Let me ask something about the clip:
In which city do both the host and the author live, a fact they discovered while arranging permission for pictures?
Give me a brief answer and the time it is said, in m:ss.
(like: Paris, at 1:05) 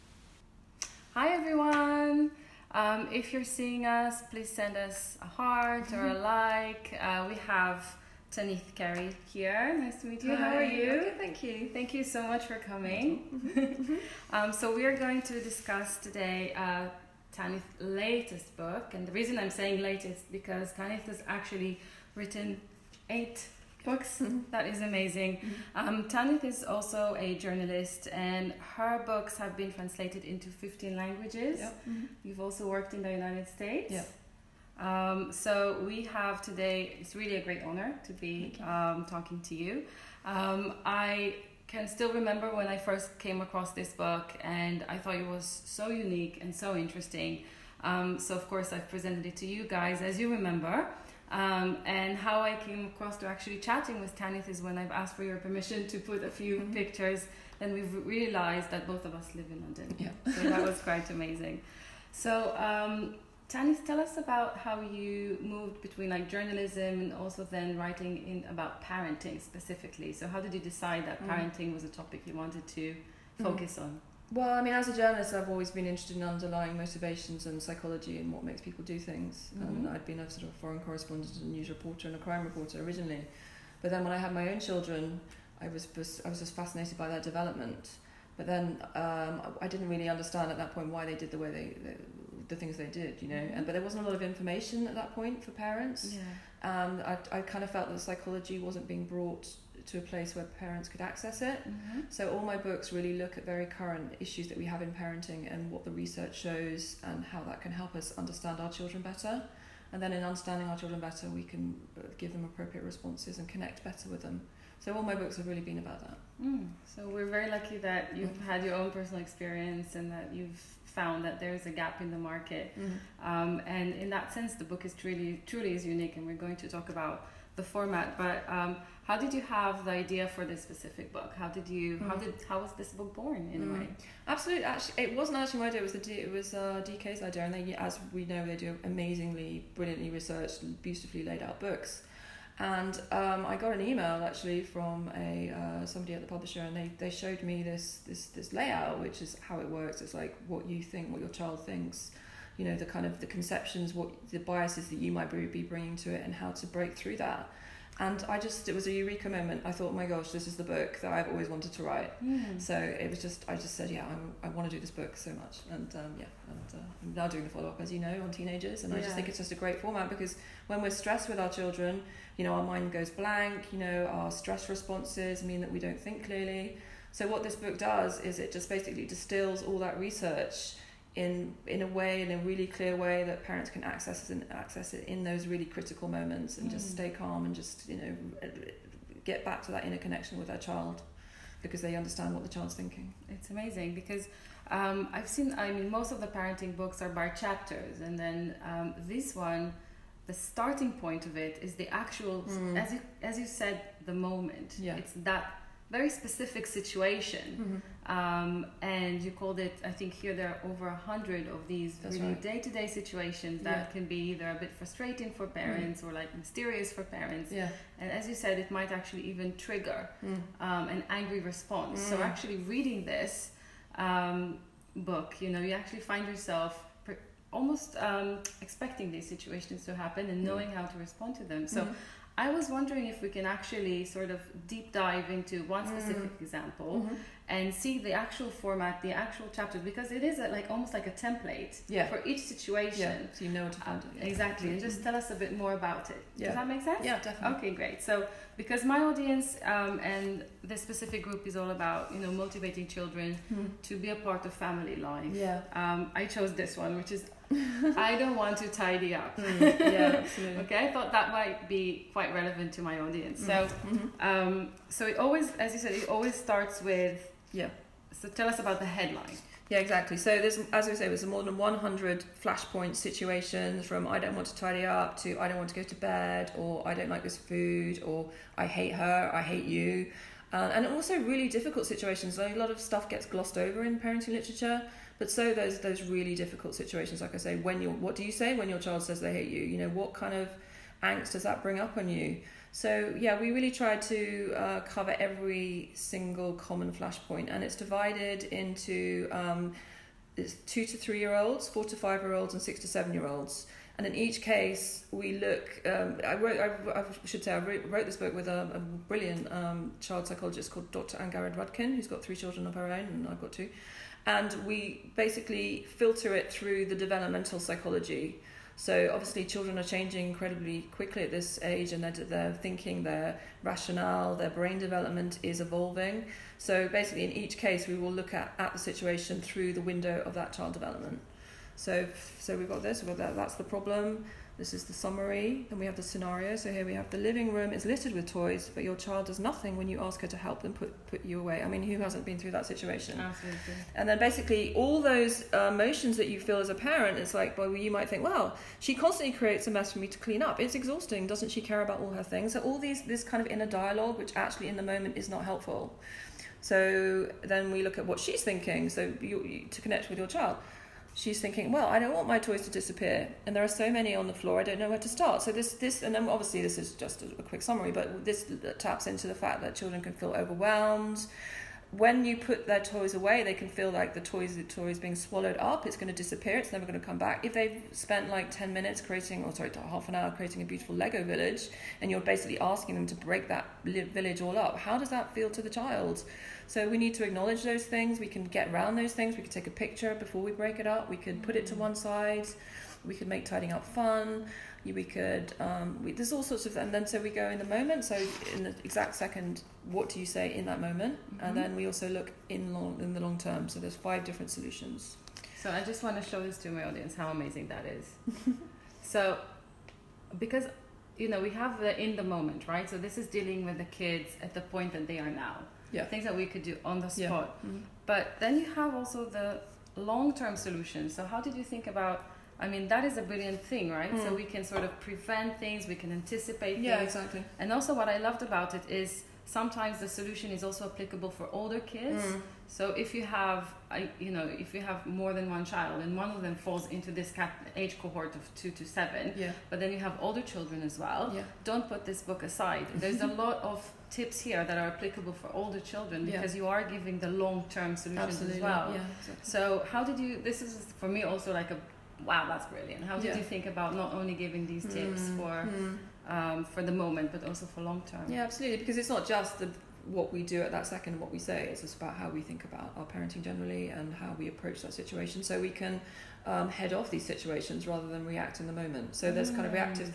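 London, at 0:59.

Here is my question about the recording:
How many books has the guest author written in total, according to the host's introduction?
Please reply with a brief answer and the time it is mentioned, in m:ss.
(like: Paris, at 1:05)
8, at 0:23.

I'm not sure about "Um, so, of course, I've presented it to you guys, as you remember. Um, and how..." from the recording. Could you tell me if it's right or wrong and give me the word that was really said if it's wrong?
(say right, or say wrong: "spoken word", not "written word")
right.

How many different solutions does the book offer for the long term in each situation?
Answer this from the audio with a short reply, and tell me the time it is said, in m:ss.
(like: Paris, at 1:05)
5, at 6:43.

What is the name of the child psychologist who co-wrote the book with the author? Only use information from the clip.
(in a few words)
Dr. 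Angharad Rudkin.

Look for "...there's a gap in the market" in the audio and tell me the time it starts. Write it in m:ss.
2:01.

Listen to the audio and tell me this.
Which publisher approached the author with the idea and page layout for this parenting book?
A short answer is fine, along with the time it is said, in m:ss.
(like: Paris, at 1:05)
DK, at 2:16.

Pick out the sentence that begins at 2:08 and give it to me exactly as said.
But um, how did you have the idea for this specific book?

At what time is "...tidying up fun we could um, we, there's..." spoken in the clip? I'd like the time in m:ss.
6:33.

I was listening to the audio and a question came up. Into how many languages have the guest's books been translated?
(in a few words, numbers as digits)
15.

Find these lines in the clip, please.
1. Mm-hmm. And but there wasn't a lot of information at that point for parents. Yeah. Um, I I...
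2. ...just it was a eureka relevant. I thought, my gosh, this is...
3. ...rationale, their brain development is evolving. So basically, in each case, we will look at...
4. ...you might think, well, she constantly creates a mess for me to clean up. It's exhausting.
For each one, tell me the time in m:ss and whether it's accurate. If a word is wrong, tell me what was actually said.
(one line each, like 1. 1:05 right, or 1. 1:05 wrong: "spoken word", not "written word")
1. 1:33 right
2. 2:38 wrong: "moment", not "relevant"
3. 5:23 right
4. 5:47 right.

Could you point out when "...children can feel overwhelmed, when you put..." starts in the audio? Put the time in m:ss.
6:09.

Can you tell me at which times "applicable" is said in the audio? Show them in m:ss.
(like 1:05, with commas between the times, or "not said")
7:10, 7:24.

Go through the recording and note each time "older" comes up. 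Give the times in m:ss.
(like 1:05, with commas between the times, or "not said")
7:11, 7:20, 7:25.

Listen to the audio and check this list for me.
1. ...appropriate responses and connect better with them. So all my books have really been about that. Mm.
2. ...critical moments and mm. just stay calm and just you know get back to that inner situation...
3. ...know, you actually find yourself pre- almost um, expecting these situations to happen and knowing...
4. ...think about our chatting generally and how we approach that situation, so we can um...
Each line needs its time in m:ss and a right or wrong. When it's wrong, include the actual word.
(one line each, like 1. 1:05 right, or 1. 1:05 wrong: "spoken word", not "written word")
1. 1:52 right
2. 3:05 wrong: "connection", not "situation"
3. 3:45 right
4. 7:42 wrong: "parenting", not "chatting".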